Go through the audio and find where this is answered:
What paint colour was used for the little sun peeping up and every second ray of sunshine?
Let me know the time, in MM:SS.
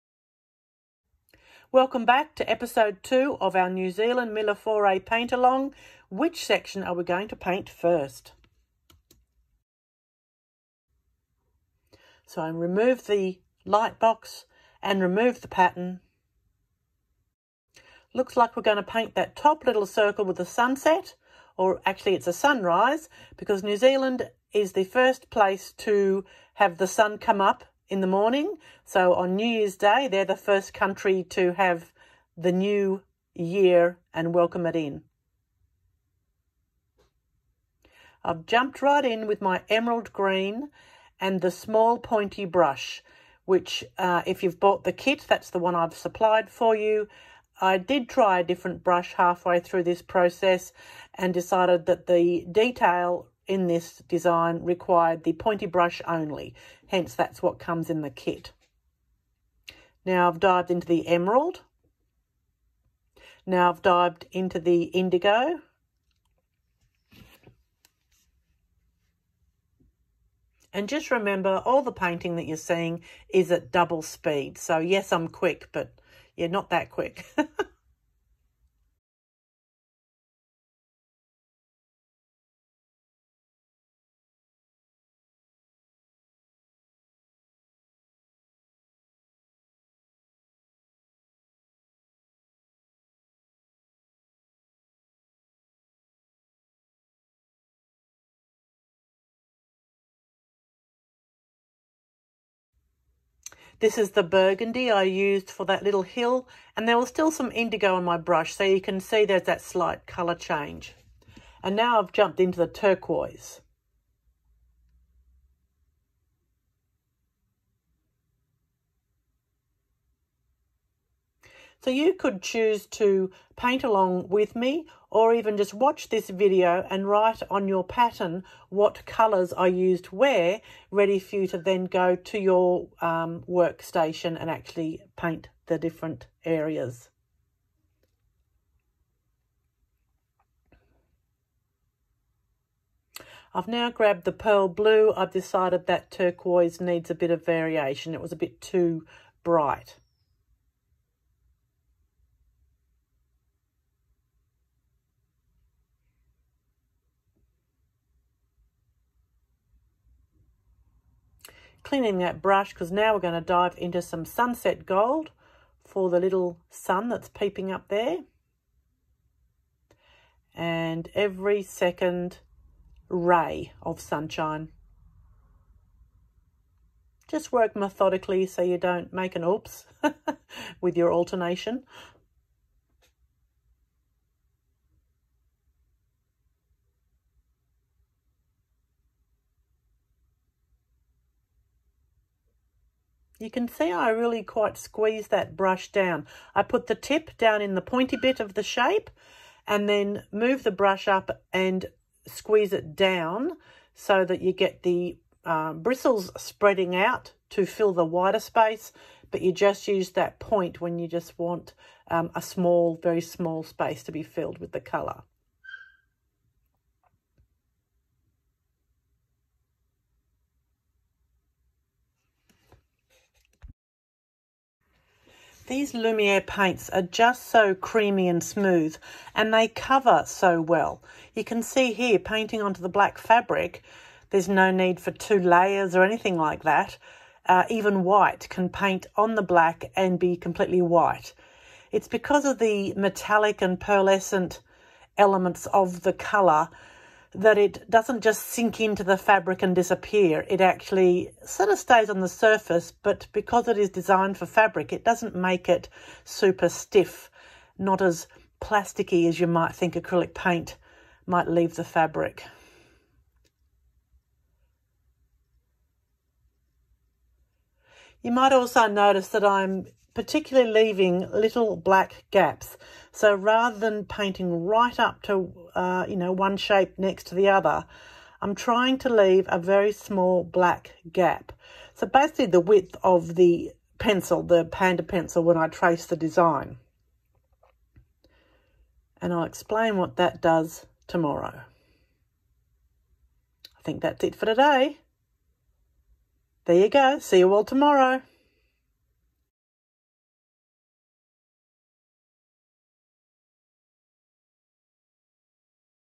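02:44.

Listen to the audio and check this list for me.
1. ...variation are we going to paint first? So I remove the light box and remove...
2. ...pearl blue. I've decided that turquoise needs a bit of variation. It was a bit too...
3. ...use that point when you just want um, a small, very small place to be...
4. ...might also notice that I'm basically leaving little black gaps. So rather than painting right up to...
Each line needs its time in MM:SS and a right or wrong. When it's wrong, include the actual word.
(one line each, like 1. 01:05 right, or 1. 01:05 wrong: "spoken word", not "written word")
1. 00:06 wrong: "section", not "variation"
2. 02:24 right
3. 03:29 wrong: "space", not "place"
4. 04:28 wrong: "particularly", not "basically".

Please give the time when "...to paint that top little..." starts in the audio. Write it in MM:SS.
00:18.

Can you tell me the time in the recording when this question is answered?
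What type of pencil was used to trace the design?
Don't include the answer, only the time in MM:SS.
04:44.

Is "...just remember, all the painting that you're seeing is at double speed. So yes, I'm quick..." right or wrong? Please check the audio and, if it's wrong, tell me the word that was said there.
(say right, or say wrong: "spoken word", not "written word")
right.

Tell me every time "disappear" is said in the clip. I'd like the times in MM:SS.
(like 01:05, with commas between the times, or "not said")
04:09.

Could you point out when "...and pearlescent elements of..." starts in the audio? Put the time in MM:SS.
04:03.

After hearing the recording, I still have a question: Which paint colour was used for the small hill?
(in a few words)
Burgundy.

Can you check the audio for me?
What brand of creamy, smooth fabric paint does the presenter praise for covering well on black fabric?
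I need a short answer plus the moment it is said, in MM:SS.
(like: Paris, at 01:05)
Lumiere, at 03:45.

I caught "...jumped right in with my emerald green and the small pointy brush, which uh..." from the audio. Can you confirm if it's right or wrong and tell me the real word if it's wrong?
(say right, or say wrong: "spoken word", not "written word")
right.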